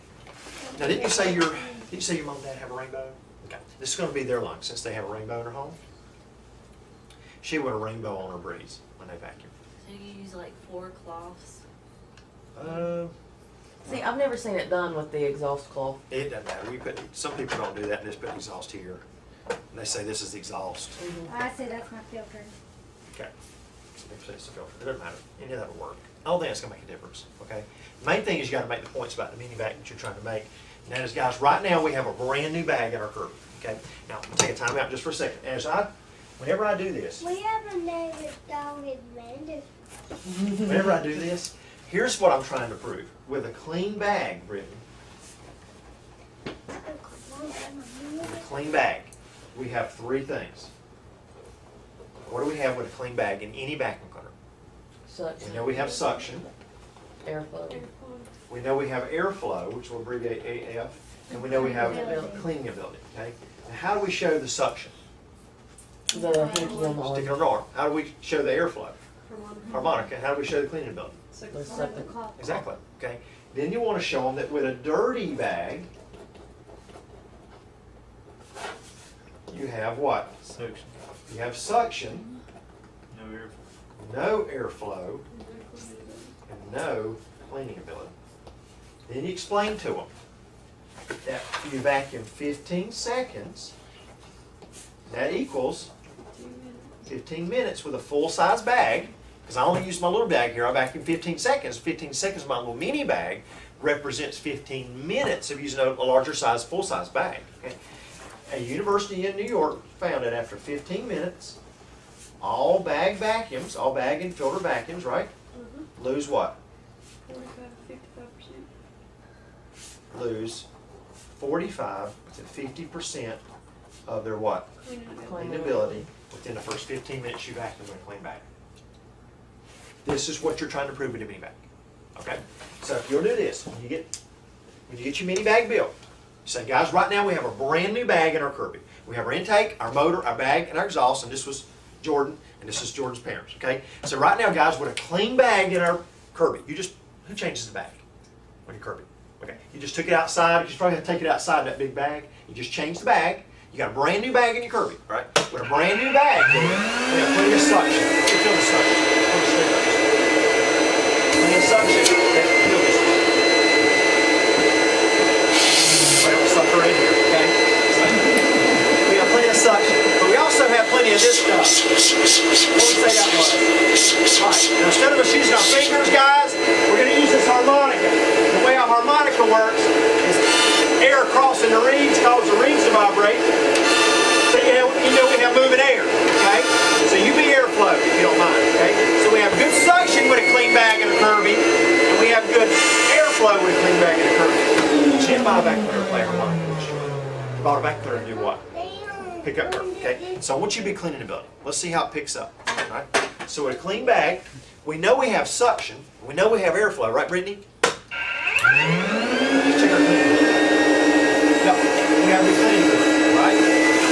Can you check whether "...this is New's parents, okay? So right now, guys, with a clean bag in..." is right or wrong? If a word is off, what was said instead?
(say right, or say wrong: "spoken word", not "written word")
wrong: "Jordan", not "New".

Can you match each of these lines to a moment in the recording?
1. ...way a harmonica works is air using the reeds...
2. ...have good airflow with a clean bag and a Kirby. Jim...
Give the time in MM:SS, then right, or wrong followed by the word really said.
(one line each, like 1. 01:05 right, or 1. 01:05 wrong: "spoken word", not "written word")
1. 02:58 wrong: "crossing", not "using"
2. 03:12 right.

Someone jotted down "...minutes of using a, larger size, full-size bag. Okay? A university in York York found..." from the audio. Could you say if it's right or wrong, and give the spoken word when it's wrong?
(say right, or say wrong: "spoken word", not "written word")
wrong: "New", not "York".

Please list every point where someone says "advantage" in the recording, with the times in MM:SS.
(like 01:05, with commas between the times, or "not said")
00:38.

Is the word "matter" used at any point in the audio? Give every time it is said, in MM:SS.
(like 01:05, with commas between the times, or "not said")
00:16, 00:25.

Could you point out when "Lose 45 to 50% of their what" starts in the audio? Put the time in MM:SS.
02:00.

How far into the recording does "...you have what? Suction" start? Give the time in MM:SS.
01:19.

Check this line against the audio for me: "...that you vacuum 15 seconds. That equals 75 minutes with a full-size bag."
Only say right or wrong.
wrong.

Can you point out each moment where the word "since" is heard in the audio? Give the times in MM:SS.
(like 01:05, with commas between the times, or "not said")
00:04.